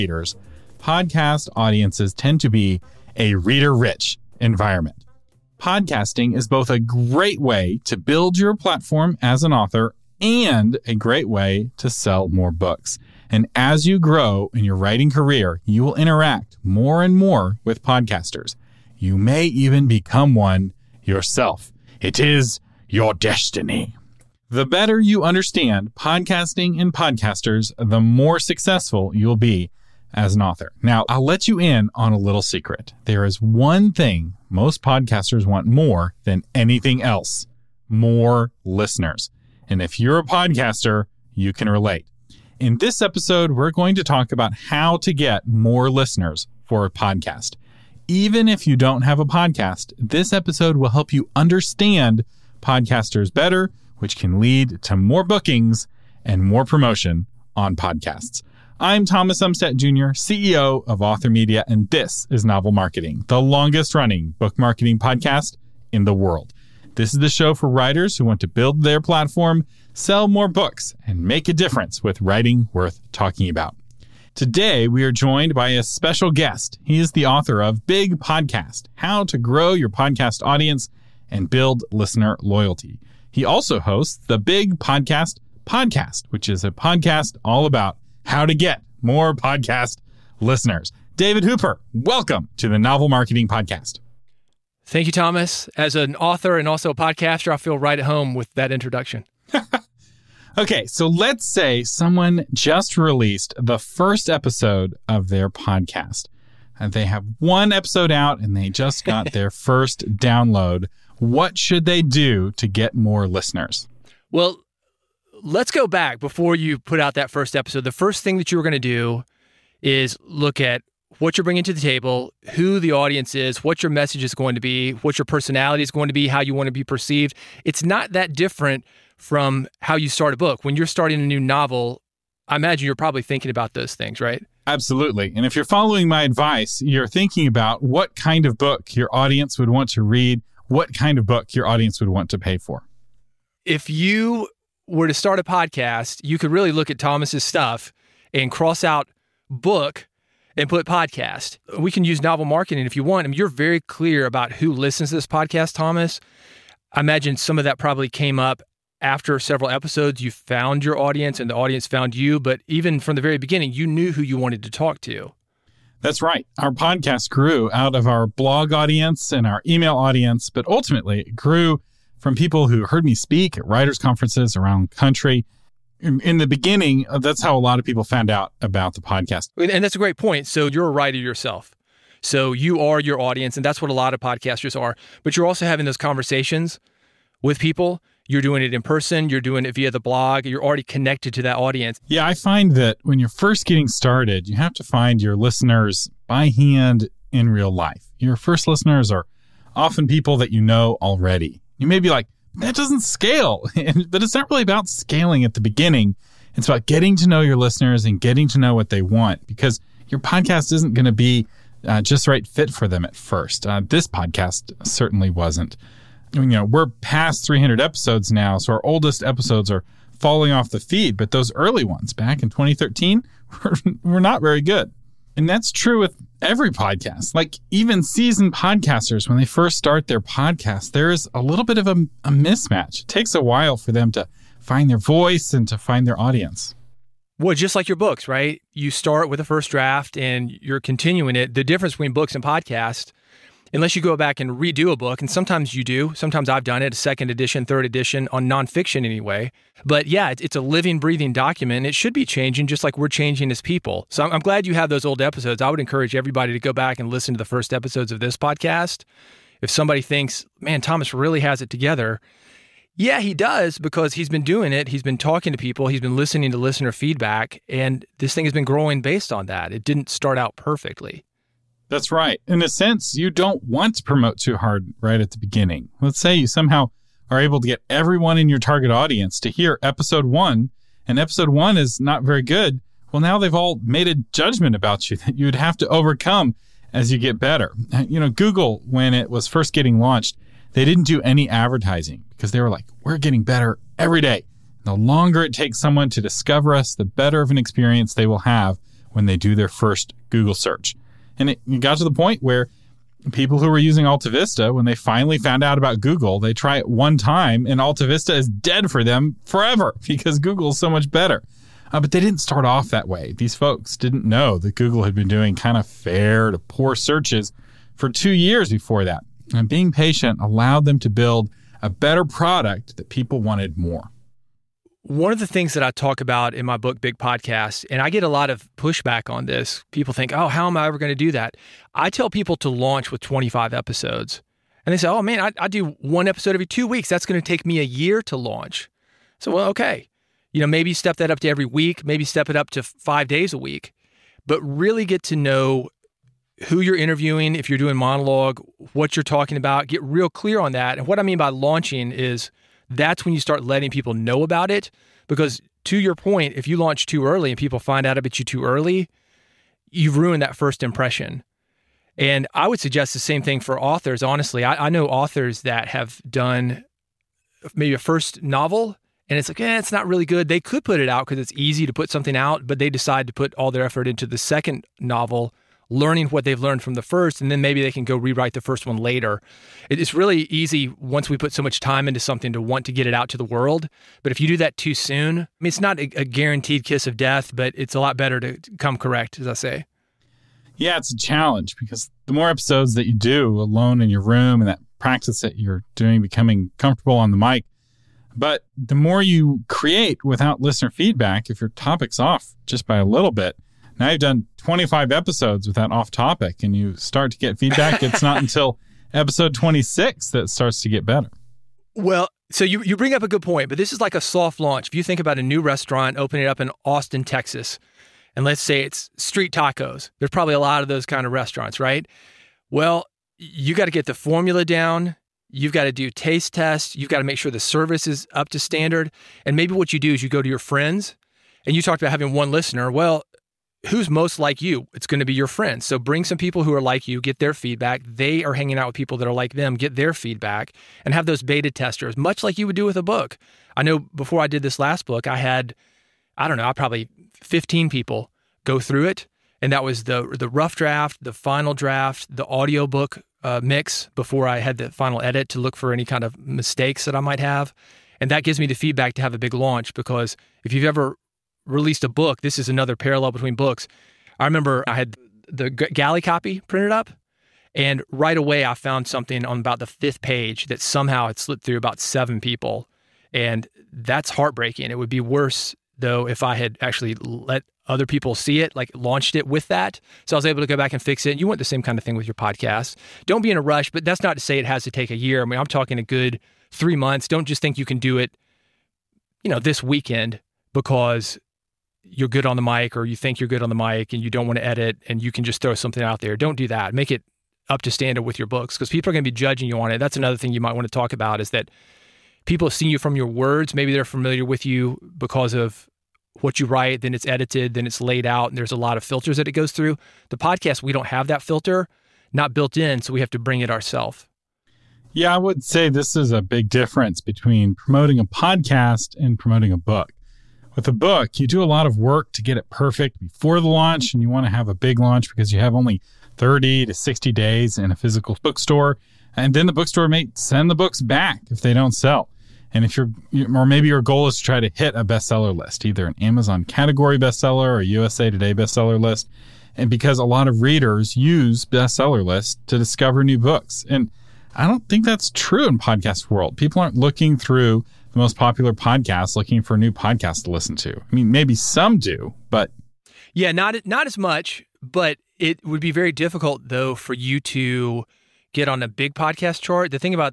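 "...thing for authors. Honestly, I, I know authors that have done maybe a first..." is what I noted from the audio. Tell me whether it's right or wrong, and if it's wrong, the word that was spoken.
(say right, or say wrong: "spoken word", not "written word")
right.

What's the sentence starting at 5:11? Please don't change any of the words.
Uh, but they didn't start off that way.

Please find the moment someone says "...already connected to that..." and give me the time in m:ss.
3:10.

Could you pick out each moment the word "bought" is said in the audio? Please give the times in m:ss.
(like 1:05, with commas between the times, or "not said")
not said.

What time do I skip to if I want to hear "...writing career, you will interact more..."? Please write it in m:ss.
0:14.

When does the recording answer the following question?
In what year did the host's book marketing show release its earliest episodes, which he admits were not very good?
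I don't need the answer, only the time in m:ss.
3:42.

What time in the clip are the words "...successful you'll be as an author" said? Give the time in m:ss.
0:28.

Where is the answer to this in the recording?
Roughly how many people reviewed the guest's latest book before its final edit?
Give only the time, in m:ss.
7:27.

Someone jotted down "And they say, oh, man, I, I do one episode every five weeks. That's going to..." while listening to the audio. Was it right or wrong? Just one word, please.
wrong.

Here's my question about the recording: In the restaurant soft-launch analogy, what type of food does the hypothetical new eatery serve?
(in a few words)
Street tacos.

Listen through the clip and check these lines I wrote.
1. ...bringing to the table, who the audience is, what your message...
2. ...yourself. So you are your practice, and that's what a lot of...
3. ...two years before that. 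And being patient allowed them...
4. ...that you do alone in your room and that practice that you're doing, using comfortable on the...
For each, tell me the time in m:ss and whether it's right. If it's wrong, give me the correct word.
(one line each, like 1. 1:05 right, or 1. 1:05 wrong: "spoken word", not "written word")
1. 2:01 right
2. 3:01 wrong: "audience", not "practice"
3. 5:18 right
4. 6:32 wrong: "becoming", not "using".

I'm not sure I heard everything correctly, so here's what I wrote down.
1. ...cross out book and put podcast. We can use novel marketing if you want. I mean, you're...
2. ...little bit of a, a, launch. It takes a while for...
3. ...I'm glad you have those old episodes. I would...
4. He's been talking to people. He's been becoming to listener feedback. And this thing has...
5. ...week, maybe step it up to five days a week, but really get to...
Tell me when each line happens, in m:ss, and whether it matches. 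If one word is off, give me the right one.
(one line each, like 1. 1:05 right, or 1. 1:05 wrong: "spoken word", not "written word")
1. 2:28 right
2. 3:51 wrong: "mismatch", not "launch"
3. 4:14 right
4. 4:24 wrong: "listening", not "becoming"
5. 5:41 right.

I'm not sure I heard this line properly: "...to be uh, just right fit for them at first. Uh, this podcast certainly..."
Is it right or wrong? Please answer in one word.
right.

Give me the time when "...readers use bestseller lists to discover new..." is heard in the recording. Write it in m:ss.
9:00.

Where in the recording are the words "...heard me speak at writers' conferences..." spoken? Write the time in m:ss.
2:52.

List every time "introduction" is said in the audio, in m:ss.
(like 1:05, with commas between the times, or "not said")
1:38.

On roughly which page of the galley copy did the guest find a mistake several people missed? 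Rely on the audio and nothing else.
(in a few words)
Fifth page.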